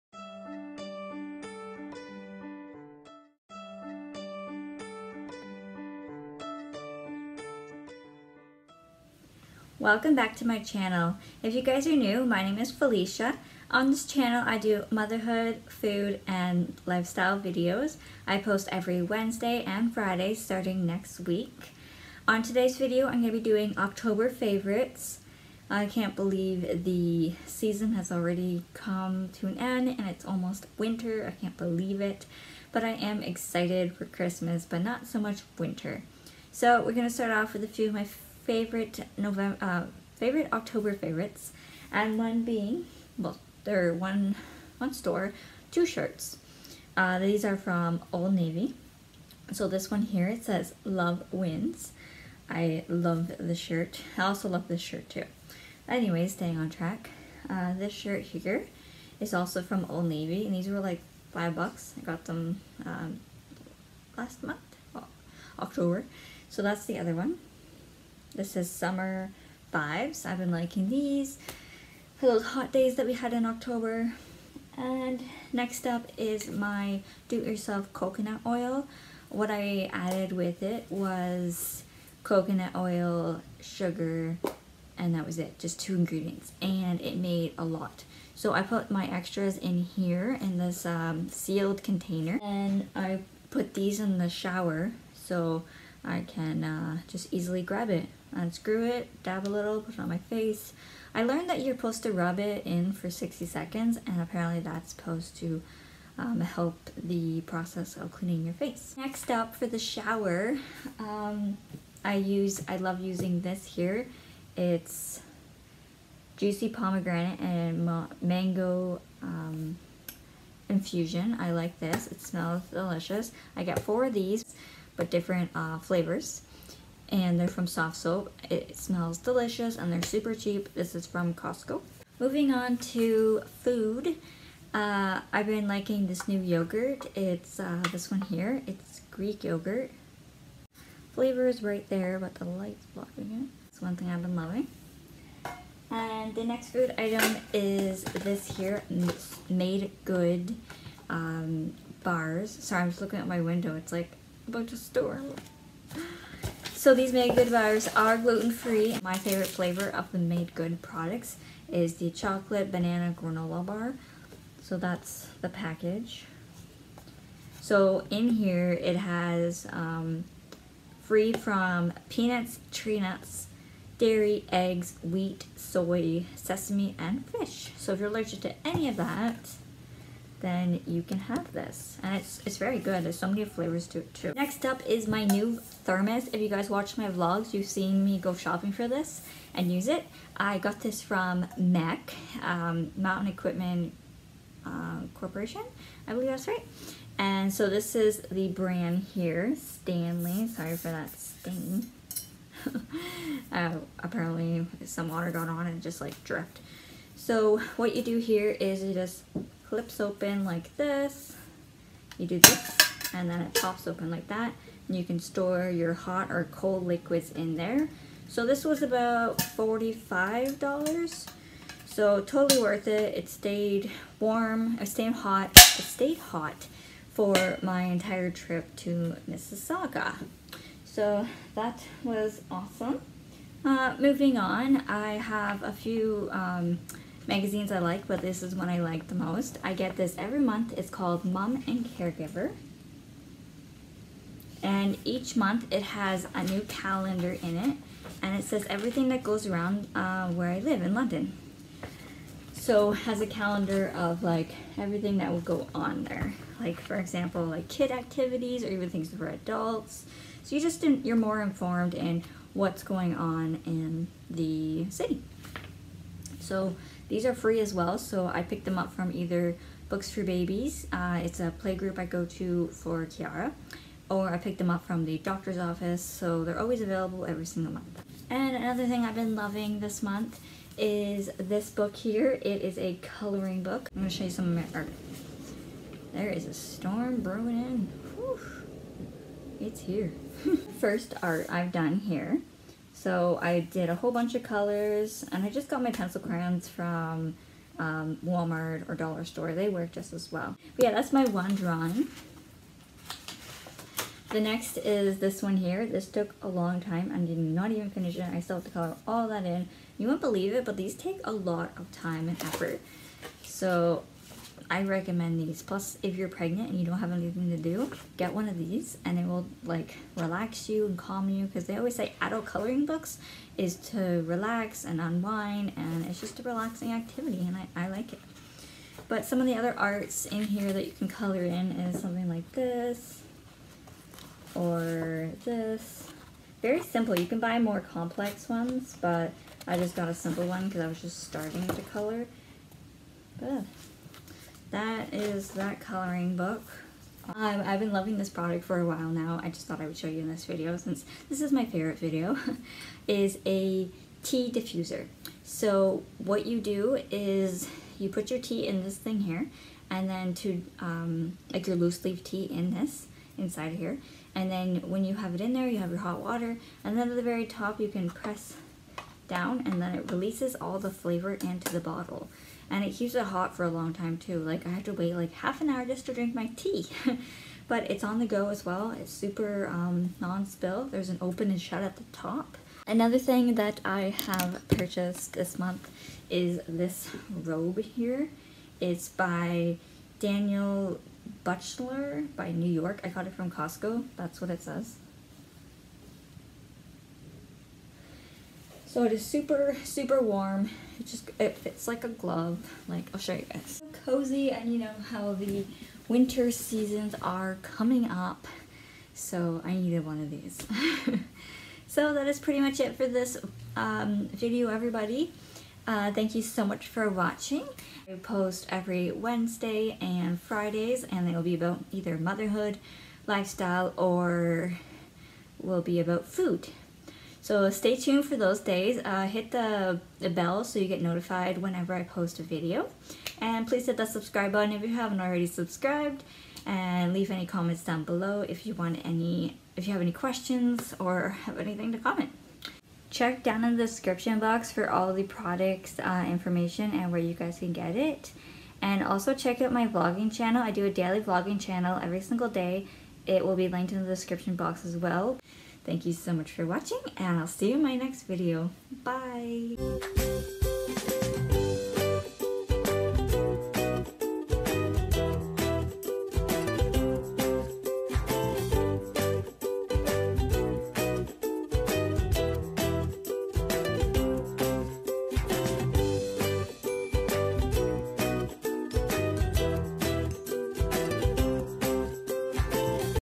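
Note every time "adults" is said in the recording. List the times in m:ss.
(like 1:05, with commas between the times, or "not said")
4:19, 5:22.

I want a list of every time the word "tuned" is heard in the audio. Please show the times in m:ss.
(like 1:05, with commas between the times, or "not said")
7:07.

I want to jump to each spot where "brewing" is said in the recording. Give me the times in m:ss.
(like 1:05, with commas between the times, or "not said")
4:47.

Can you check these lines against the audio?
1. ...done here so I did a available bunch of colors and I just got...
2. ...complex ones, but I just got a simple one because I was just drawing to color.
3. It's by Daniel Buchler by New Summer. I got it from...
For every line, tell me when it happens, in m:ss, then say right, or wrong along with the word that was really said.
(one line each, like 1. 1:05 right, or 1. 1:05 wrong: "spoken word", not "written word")
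1. 4:51 wrong: "whole", not "available"
2. 5:37 wrong: "starting", not "drawing"
3. 6:28 wrong: "York", not "Summer".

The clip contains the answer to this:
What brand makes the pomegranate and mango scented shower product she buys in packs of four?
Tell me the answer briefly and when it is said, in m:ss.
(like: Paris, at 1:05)
Soft Soap, at 2:07.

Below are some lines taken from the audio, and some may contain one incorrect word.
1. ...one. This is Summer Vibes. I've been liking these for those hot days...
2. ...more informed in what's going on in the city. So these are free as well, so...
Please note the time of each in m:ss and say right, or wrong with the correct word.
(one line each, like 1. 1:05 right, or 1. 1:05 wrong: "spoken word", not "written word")
1. 1:07 right
2. 4:21 right.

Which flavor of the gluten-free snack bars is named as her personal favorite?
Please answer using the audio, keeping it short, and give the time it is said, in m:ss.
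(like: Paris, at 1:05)
Chocolate banana, at 2:42.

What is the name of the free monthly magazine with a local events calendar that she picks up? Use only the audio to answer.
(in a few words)
Mom and Caregiver.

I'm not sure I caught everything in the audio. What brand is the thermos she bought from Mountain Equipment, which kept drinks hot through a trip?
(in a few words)
Stanley.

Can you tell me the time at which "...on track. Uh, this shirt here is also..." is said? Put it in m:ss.
0:56.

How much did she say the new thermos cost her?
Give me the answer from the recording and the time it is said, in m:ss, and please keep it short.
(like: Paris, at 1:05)
$45, at 3:39.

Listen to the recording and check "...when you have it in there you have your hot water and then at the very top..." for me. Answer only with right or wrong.
right.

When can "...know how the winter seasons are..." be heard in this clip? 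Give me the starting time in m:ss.
6:44.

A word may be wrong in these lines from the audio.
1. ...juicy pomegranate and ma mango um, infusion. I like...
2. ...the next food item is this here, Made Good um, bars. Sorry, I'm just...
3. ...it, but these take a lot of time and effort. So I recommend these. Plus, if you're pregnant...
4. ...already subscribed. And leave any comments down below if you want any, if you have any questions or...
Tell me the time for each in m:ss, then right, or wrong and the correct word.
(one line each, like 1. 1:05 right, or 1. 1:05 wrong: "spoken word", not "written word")
1. 1:56 right
2. 2:26 right
3. 5:10 right
4. 7:15 right.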